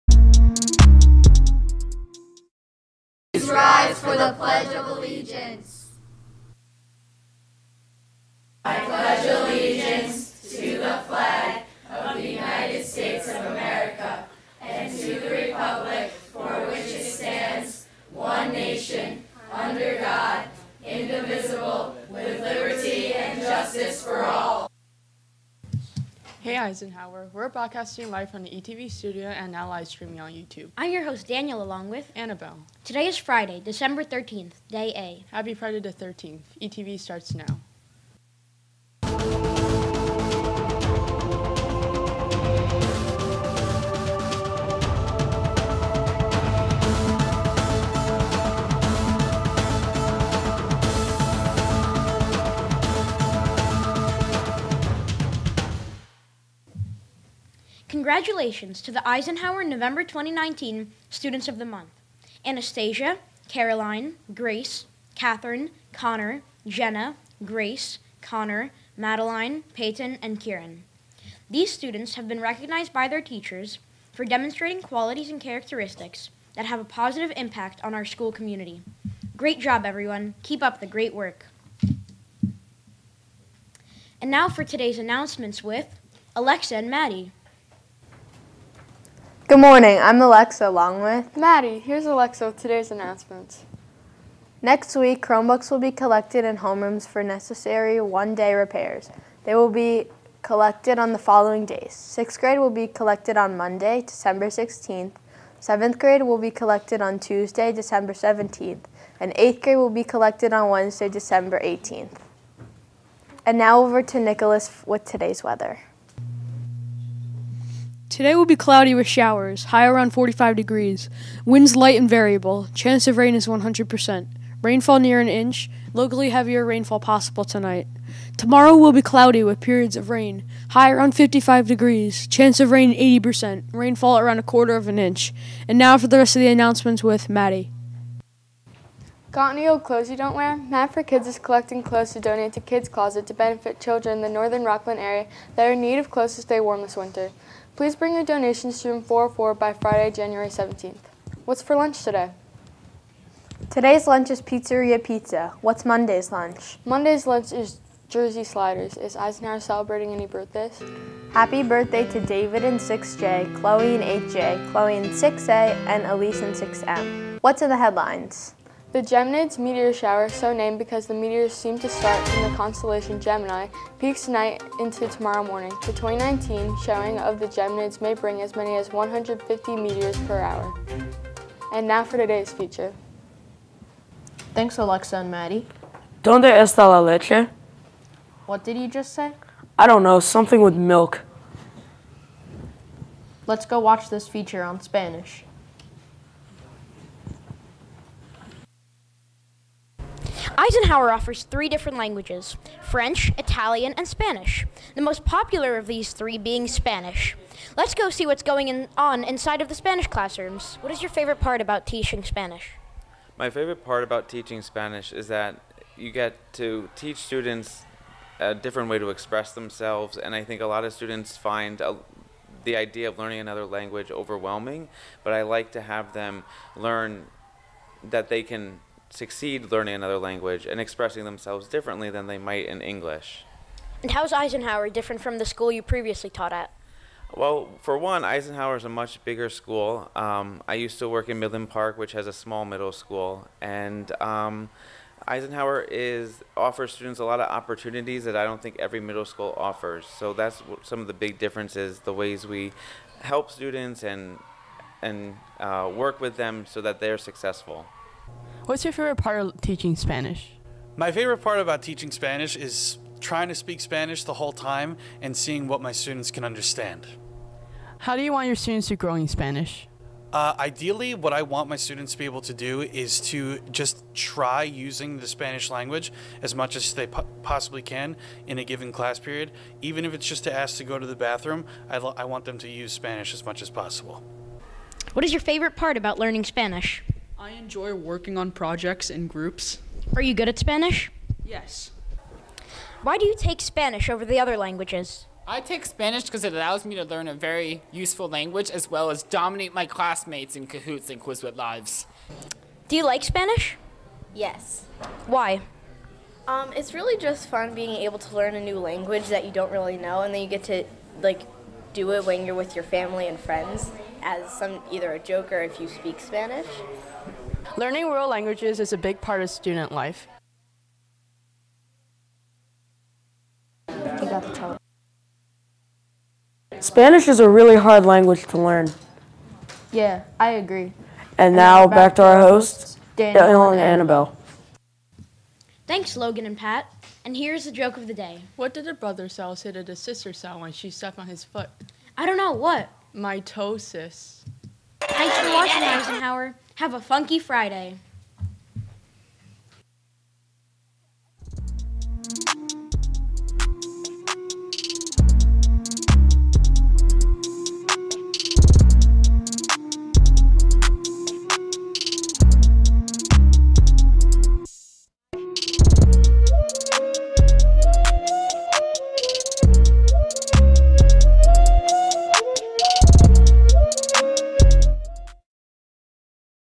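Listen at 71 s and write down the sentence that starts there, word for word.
These students have been recognized by their teachers for demonstrating qualities and characteristics that have a positive impact on our school community.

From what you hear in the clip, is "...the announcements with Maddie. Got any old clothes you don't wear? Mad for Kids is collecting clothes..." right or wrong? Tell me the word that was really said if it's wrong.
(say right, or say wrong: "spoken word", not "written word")
right.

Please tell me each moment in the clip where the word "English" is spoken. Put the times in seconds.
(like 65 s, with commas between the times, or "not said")
232 s.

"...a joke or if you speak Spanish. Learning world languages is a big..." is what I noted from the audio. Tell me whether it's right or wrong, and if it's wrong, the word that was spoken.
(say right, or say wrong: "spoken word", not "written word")
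right.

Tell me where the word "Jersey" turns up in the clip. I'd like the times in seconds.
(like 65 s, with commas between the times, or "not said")
158 s.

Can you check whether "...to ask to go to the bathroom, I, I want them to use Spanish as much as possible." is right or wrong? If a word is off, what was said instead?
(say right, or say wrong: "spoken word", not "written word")
right.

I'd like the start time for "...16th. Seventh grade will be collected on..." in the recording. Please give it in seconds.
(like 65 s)
104 s.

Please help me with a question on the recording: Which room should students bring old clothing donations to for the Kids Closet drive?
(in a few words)
Room 404.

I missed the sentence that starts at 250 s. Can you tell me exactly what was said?
So that's some of the big differences, the ways we help students and and uh, work with them so that they're successful.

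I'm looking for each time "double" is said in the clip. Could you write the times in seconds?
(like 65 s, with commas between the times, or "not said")
not said.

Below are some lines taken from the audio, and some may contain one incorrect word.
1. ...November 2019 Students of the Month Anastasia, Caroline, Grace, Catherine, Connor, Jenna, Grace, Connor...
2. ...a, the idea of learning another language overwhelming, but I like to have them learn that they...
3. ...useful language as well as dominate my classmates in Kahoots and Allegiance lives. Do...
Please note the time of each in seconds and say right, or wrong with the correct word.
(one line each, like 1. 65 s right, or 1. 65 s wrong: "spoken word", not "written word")
1. 59 s right
2. 221 s right
3. 297 s wrong: "Quizlet", not "Allegiance".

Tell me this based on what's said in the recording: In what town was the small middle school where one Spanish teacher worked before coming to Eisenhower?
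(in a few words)
Midland Park.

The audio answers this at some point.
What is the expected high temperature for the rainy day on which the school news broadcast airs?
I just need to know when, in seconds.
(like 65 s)
120 s.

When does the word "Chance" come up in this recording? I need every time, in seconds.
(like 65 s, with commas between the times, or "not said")
122 s, 132 s.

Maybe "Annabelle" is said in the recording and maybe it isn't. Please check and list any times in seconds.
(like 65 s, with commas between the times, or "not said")
32 s, 333 s.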